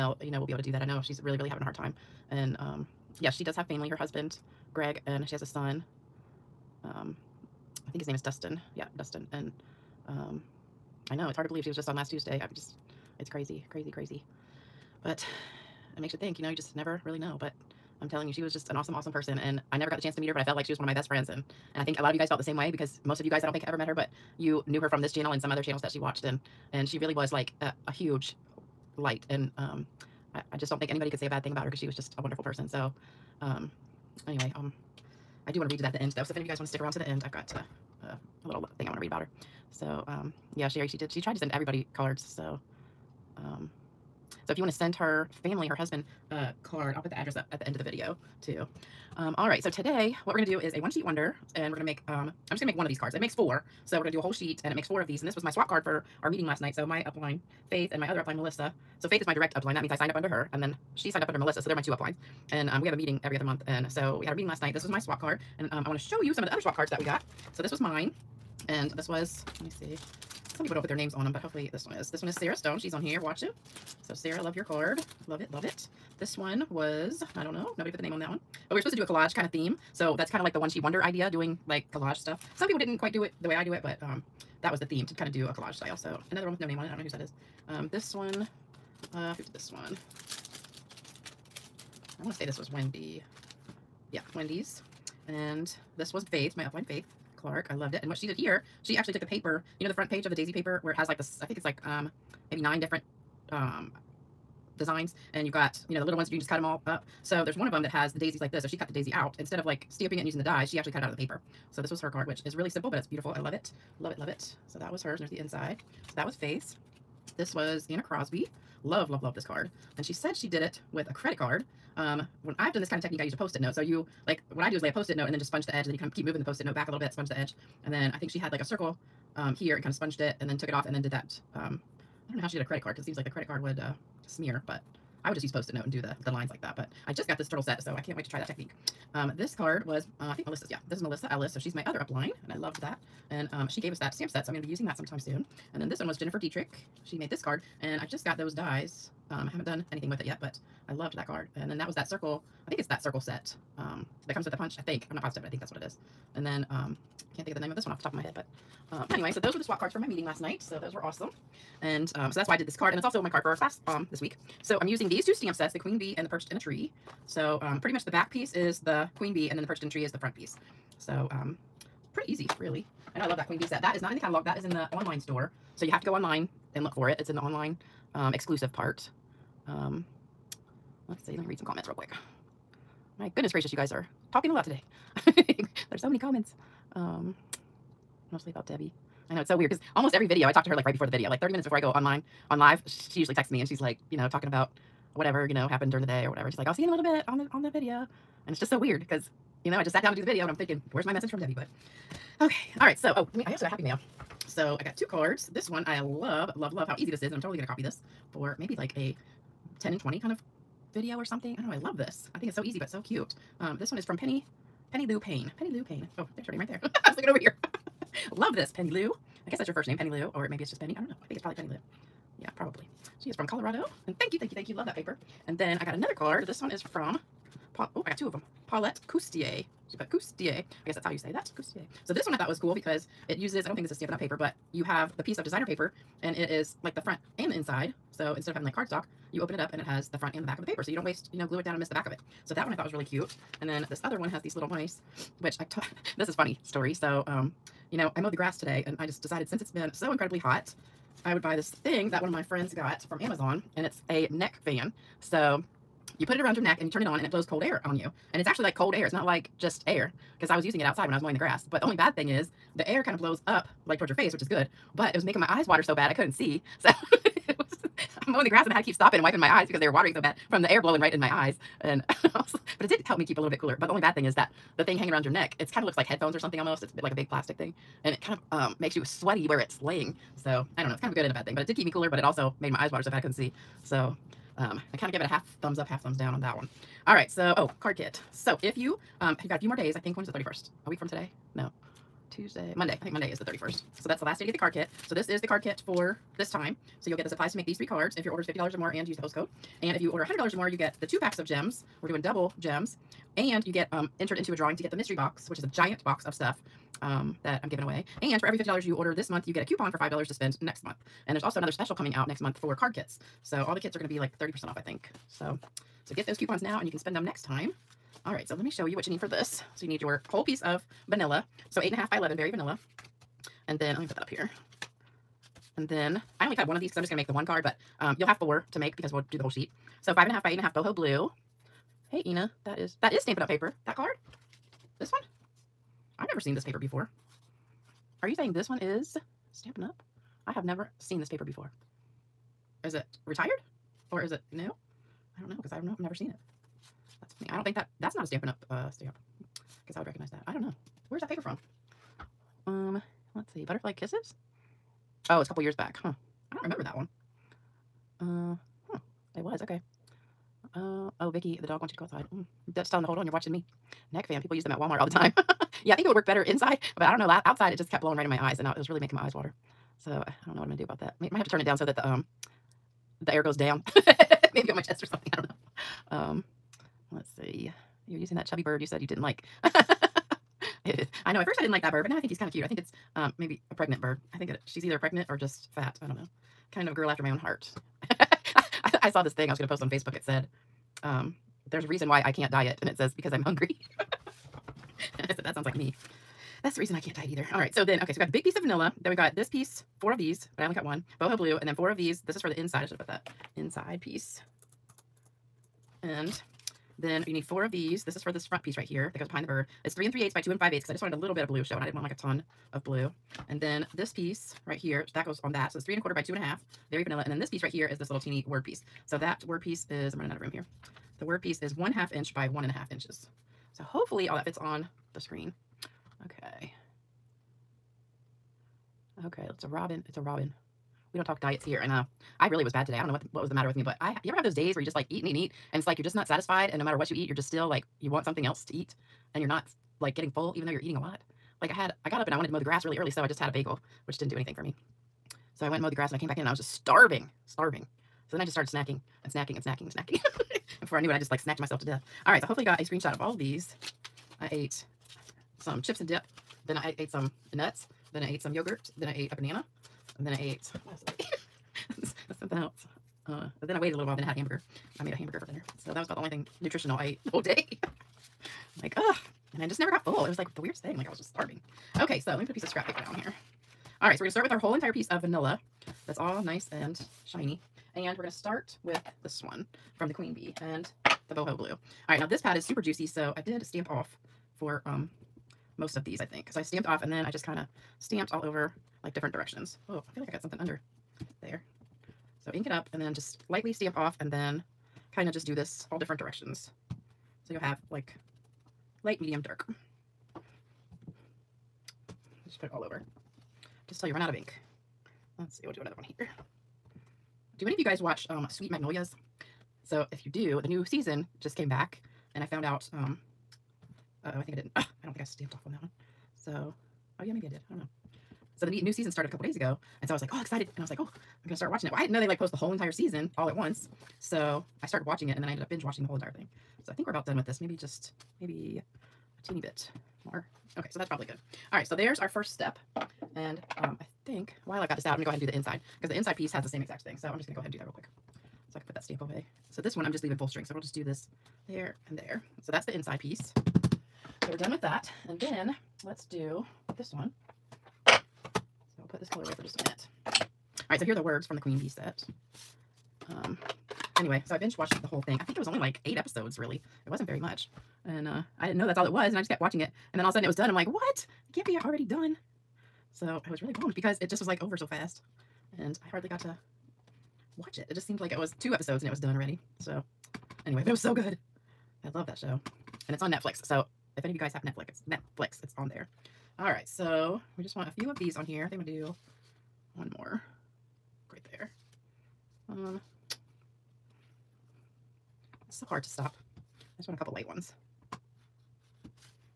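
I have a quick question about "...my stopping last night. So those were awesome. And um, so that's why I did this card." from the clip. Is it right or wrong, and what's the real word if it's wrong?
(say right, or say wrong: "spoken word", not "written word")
wrong: "meeting", not "stopping".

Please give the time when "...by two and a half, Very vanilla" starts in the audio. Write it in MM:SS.
06:56.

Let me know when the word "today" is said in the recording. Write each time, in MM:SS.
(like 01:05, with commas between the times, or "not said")
00:49, 03:04, 04:08, 04:51, 07:12.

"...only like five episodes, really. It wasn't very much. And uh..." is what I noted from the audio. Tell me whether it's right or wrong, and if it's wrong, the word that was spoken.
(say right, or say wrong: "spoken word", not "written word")
wrong: "eight", not "five".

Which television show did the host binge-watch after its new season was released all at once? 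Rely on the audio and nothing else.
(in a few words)
Sweet Magnolias.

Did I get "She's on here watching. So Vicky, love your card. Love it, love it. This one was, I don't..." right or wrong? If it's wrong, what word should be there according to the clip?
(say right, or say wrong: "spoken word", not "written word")
wrong: "Sarah", not "Vicky".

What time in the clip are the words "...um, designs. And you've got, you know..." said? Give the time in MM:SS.
01:43.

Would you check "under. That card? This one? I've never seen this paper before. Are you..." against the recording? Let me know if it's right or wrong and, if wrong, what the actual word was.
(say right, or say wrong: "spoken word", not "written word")
wrong: "paper", not "under".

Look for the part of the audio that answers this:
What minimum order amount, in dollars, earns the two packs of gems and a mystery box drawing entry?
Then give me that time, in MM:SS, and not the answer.
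05:00.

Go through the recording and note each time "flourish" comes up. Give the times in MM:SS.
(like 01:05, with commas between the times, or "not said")
not said.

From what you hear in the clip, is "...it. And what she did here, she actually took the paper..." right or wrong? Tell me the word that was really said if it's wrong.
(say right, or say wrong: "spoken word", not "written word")
right.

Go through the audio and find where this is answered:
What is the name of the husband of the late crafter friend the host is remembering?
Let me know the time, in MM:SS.
00:04.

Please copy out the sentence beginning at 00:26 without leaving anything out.
And, and she really was like a, a huge light.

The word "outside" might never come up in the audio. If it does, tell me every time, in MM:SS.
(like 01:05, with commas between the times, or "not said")
04:20, 06:02, 06:07.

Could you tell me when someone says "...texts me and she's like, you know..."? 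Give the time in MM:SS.
03:13.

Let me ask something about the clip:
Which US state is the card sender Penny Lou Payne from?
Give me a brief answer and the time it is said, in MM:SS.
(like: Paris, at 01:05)
Colorado, at 03:43.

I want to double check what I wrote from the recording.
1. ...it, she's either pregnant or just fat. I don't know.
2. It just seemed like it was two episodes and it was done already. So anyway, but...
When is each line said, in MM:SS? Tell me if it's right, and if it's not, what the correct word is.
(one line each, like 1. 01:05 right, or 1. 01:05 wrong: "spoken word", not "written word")
1. 06:24 right
2. 09:27 right.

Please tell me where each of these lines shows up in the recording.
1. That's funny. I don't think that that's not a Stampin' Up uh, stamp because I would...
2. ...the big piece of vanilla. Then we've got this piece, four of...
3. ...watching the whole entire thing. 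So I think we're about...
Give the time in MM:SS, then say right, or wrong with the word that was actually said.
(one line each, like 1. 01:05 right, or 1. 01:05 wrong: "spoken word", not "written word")
1. 05:47 right
2. 06:38 right
3. 08:45 right.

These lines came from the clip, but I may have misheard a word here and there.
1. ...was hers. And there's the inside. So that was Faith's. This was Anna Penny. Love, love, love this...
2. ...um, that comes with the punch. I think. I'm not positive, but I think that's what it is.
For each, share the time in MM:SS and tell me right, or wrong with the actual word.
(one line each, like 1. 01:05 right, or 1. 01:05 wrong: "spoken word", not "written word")
1. 01:54 wrong: "Crosby", not "Penny"
2. 02:33 right.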